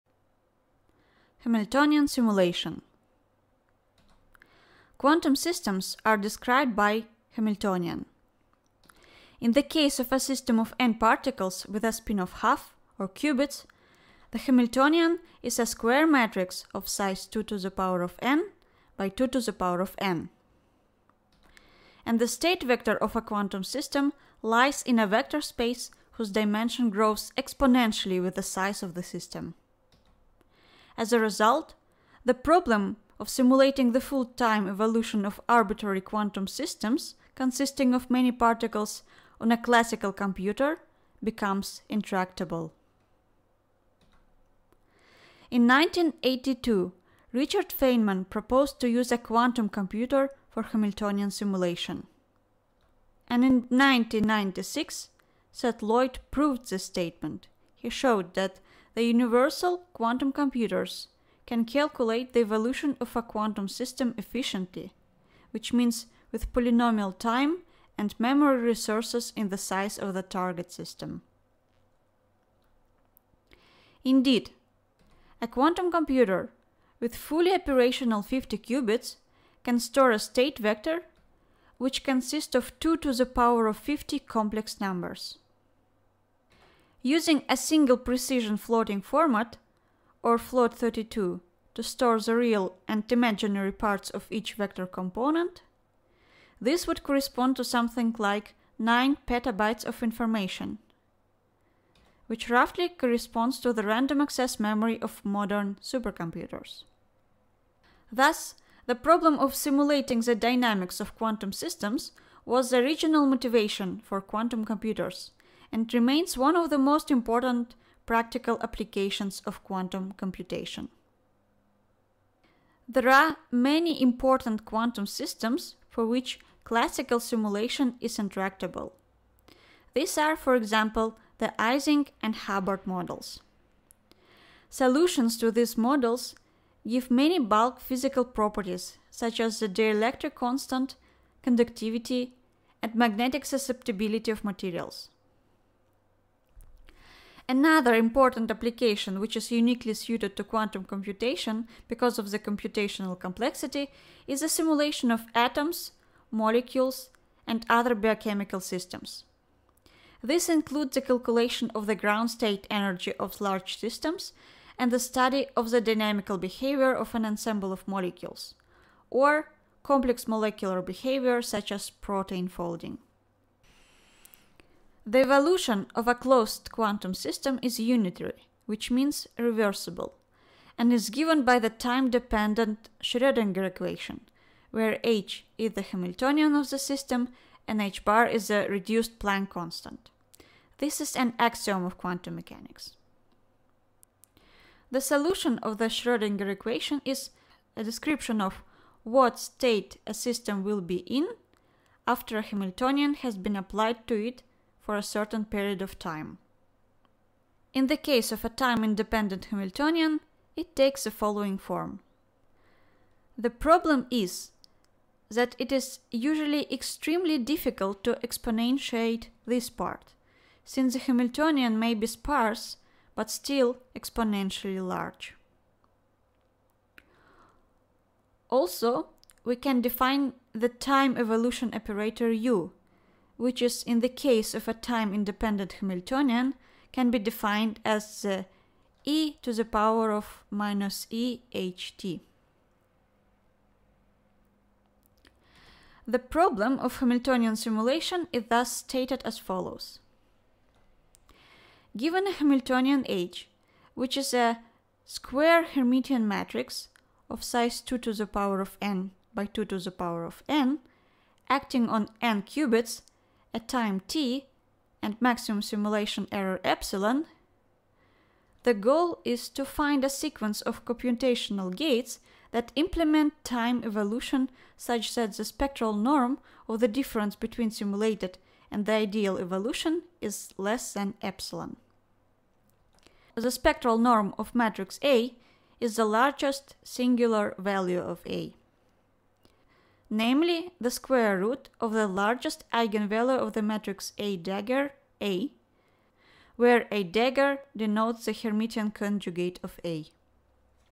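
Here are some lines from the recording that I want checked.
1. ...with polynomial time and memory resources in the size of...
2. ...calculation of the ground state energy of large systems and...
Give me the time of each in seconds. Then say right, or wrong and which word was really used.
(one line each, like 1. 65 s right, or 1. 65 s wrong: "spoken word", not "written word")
1. 66 s right
2. 161 s right.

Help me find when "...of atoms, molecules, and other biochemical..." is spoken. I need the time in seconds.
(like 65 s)
155 s.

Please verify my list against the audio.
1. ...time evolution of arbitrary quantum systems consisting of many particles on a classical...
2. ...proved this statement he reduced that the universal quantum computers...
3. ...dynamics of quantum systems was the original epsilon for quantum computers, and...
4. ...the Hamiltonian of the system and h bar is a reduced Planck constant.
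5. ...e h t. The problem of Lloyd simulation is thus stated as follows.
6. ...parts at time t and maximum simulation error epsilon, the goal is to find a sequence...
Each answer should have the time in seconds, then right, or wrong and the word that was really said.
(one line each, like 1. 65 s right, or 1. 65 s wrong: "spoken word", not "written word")
1. 34 s right
2. 56 s wrong: "showed", not "reduced"
3. 110 s wrong: "motivation", not "epsilon"
4. 185 s right
5. 241 s wrong: "Hamiltonian", not "Lloyd"
6. 262 s wrong: "qubits", not "parts".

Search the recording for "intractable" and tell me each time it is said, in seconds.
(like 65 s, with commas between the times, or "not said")
41 s, 128 s.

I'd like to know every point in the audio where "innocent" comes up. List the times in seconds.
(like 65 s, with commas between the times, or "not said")
not said.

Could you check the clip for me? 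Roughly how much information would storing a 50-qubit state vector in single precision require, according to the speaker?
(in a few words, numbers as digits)
9 petabytes.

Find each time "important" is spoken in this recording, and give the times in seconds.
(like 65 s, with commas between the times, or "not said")
117 s, 124 s, 147 s.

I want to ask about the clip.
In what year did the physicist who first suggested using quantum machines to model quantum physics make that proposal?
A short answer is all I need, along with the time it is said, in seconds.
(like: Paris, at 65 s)
1982, at 45 s.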